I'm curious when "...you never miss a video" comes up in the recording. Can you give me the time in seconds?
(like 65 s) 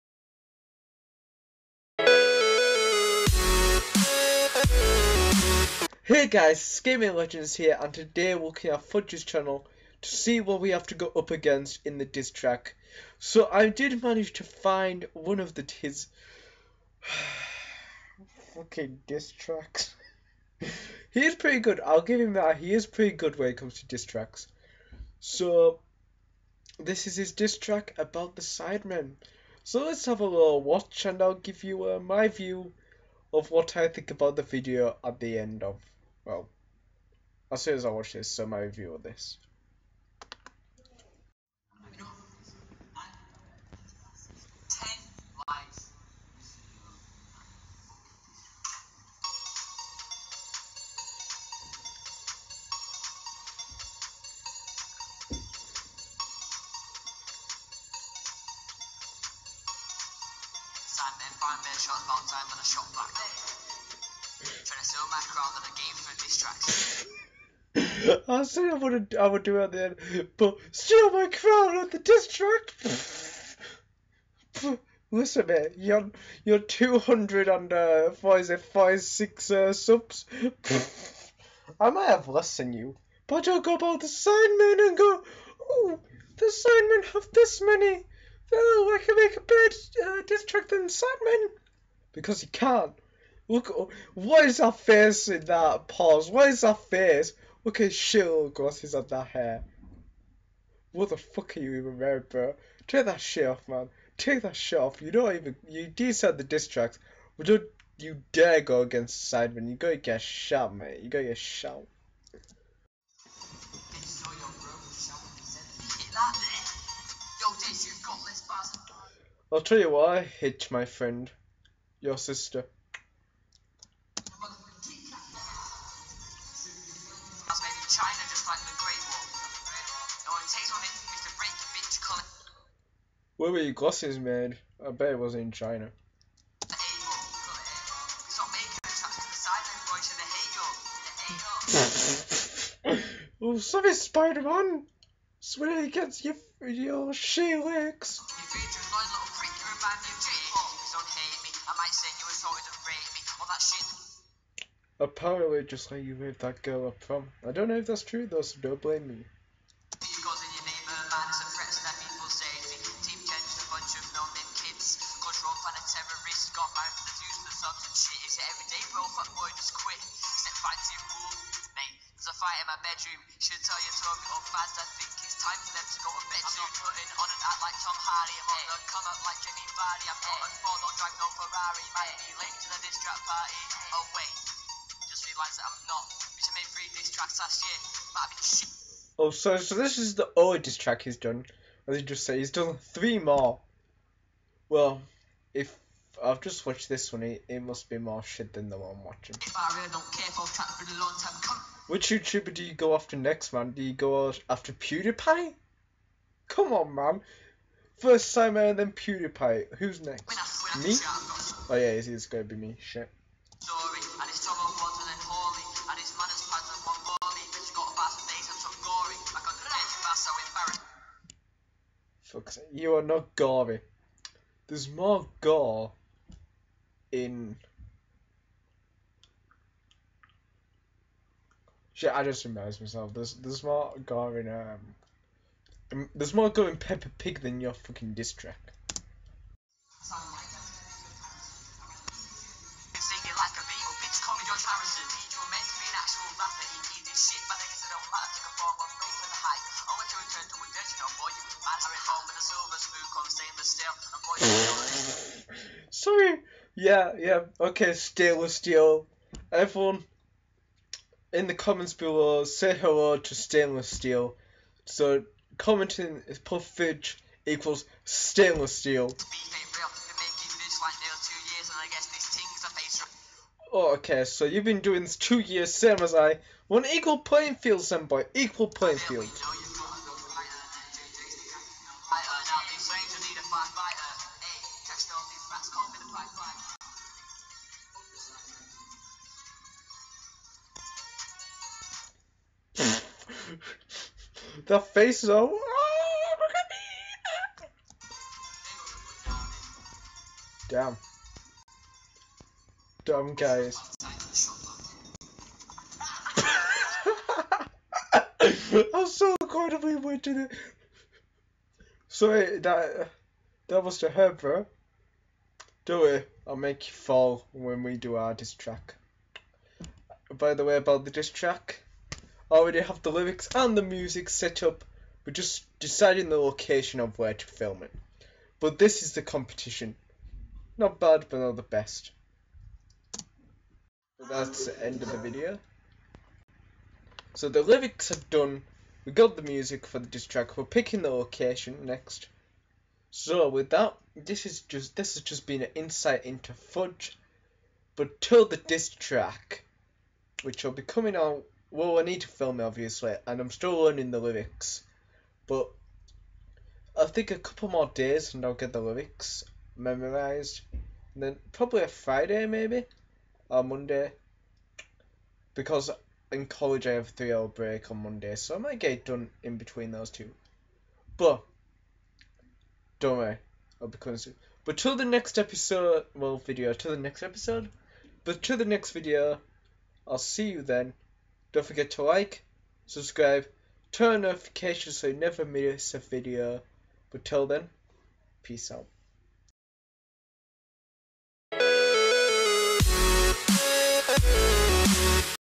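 385 s.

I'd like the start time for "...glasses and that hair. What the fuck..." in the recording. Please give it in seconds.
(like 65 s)
98 s.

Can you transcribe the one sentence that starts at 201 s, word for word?
Which YouTuber do you go after next, man?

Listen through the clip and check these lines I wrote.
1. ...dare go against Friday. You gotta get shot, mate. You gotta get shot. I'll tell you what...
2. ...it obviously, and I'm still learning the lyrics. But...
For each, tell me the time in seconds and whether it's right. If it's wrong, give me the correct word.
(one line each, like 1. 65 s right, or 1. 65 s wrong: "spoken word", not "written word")
1. 108 s wrong: "Sidemen", not "Friday"
2. 352 s right.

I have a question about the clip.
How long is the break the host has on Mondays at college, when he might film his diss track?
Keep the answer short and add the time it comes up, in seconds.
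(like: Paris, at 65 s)
3 hours, at 367 s.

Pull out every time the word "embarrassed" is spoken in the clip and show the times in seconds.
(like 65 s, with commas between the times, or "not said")
232 s.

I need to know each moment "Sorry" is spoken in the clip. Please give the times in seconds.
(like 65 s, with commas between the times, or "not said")
255 s, 312 s.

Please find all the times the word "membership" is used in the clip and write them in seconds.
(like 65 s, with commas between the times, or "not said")
not said.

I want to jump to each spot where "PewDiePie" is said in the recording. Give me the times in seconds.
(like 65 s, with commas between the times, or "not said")
204 s, 208 s.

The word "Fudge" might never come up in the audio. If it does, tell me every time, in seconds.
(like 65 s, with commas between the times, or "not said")
8 s, 346 s.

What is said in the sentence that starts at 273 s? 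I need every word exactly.
Oh, okay, so you've been doing this two years, same as I.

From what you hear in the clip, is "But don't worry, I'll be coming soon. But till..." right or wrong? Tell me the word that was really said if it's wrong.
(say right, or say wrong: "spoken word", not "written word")
right.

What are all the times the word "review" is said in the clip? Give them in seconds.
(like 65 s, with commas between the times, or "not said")
38 s.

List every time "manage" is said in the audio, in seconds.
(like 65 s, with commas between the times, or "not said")
14 s.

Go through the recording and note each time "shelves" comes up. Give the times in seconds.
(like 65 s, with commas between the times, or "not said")
not said.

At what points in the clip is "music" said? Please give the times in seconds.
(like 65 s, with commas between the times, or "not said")
323 s, 339 s.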